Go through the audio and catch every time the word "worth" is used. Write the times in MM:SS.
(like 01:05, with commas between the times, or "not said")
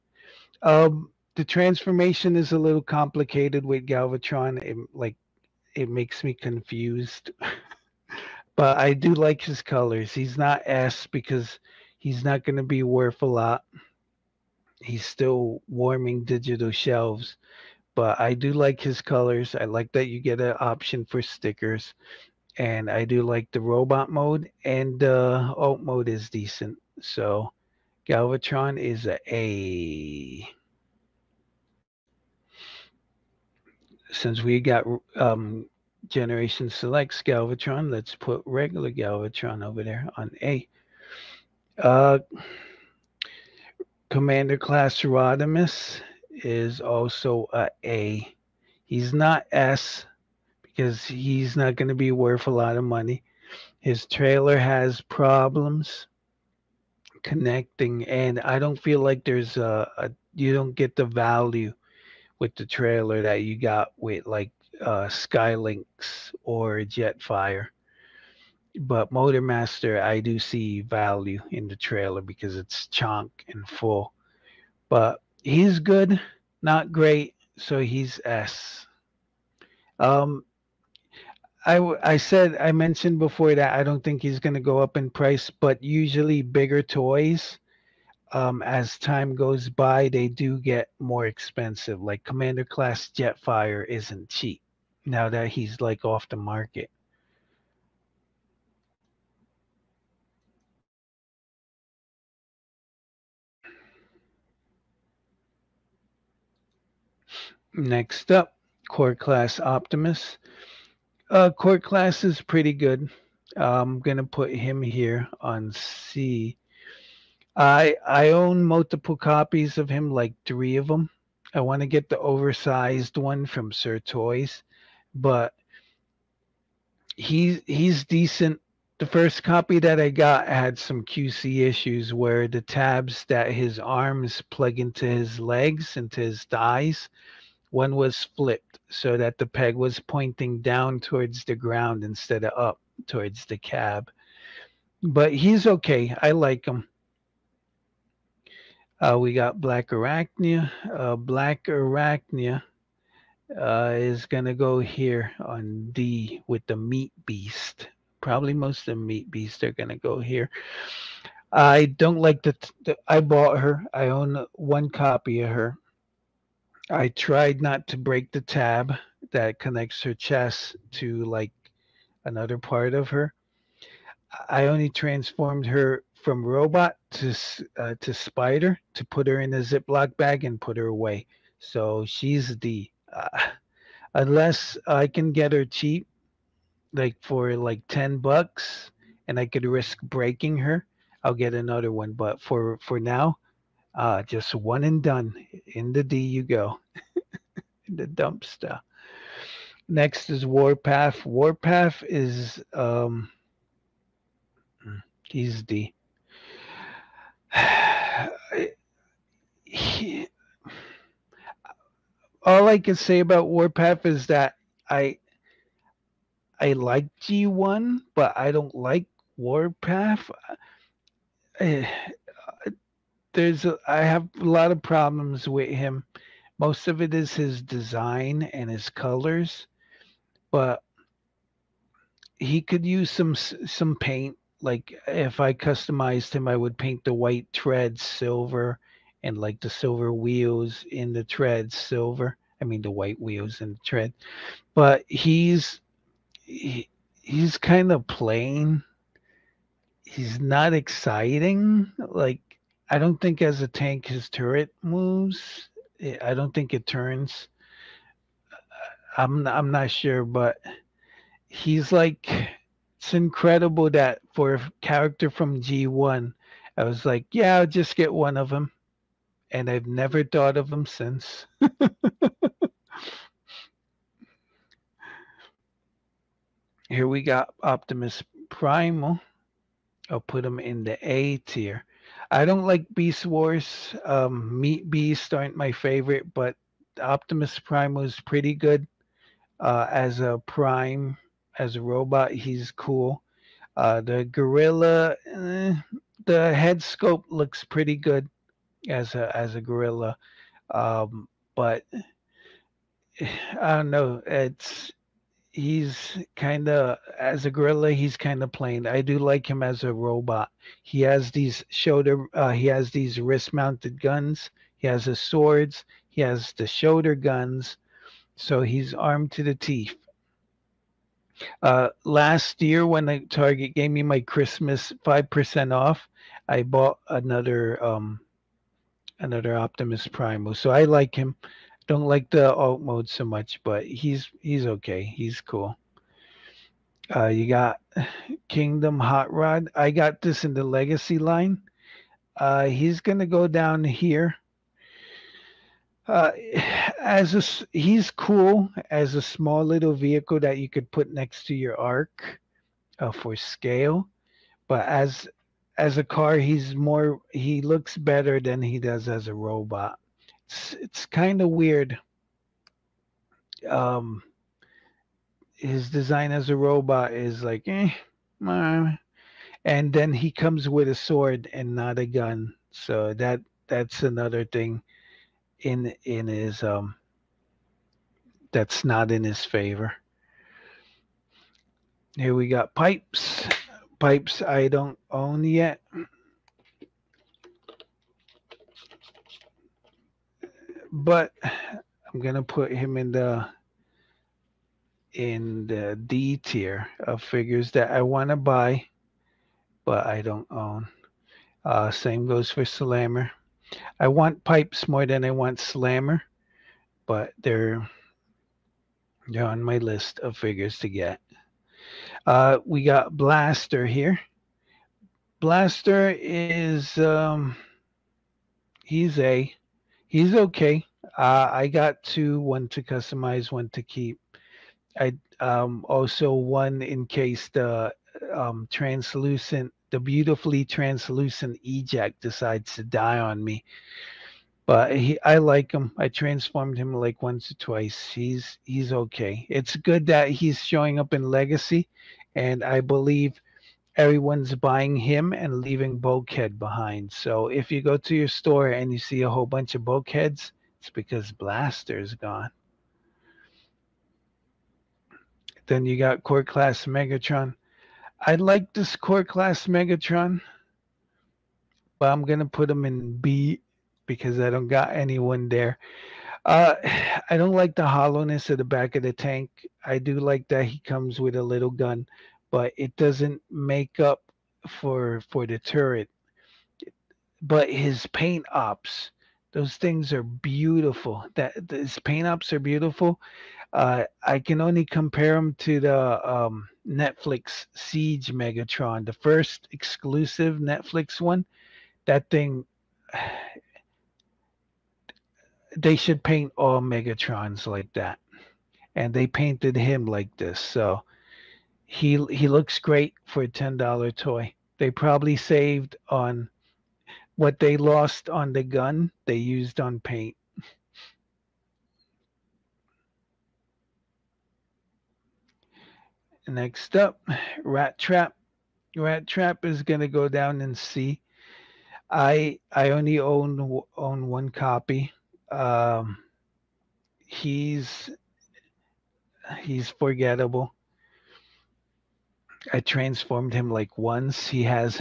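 00:12, 00:52.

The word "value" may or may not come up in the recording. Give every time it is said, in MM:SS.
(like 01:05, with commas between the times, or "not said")
01:01, 01:10.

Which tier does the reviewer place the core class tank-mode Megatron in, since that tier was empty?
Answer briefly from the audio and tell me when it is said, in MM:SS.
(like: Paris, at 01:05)
B, at 07:43.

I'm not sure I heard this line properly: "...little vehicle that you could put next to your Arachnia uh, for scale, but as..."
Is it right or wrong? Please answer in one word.
wrong.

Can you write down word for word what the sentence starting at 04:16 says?
Eh, I don't think it turns.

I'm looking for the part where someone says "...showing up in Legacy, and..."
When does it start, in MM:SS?
07:20.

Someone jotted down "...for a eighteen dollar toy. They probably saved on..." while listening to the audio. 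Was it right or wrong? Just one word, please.
wrong.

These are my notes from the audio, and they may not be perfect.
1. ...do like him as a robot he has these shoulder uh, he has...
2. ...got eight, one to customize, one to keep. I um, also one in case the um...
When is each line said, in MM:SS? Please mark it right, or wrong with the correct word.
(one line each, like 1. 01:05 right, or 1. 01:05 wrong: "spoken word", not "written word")
1. 05:09 right
2. 07:01 wrong: "two", not "eight".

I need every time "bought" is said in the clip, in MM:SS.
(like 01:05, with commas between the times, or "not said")
02:43, 05:26.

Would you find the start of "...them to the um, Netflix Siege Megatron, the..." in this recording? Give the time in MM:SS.
08:05.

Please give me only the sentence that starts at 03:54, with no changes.
Like if I customized him, I would paint the white tread silver and like the silver wheels in the tread silver.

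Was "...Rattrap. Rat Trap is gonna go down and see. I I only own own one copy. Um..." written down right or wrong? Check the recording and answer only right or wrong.
right.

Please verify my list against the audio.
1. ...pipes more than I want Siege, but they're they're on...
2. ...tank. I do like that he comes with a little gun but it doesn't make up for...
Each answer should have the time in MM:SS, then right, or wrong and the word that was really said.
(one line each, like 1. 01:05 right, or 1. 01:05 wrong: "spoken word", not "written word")
1. 06:44 wrong: "Slammer", not "Siege"
2. 07:49 right.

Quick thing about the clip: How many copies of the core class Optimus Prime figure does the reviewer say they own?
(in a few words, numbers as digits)
3.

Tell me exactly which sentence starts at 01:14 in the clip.
But he's good, not great, so he's S.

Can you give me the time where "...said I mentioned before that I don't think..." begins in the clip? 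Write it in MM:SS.
01:22.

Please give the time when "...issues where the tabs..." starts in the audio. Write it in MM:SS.
02:11.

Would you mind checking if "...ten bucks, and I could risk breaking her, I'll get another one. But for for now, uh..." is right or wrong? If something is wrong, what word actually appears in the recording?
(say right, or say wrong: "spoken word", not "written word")
right.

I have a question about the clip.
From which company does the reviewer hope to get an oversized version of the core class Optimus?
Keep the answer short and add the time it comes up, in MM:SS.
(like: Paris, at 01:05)
Sir Toys, at 02:03.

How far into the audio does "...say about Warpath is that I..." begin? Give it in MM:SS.
03:32.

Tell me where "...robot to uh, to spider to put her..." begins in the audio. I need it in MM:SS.
02:56.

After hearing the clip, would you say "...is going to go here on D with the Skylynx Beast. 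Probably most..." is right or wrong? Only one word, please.
wrong.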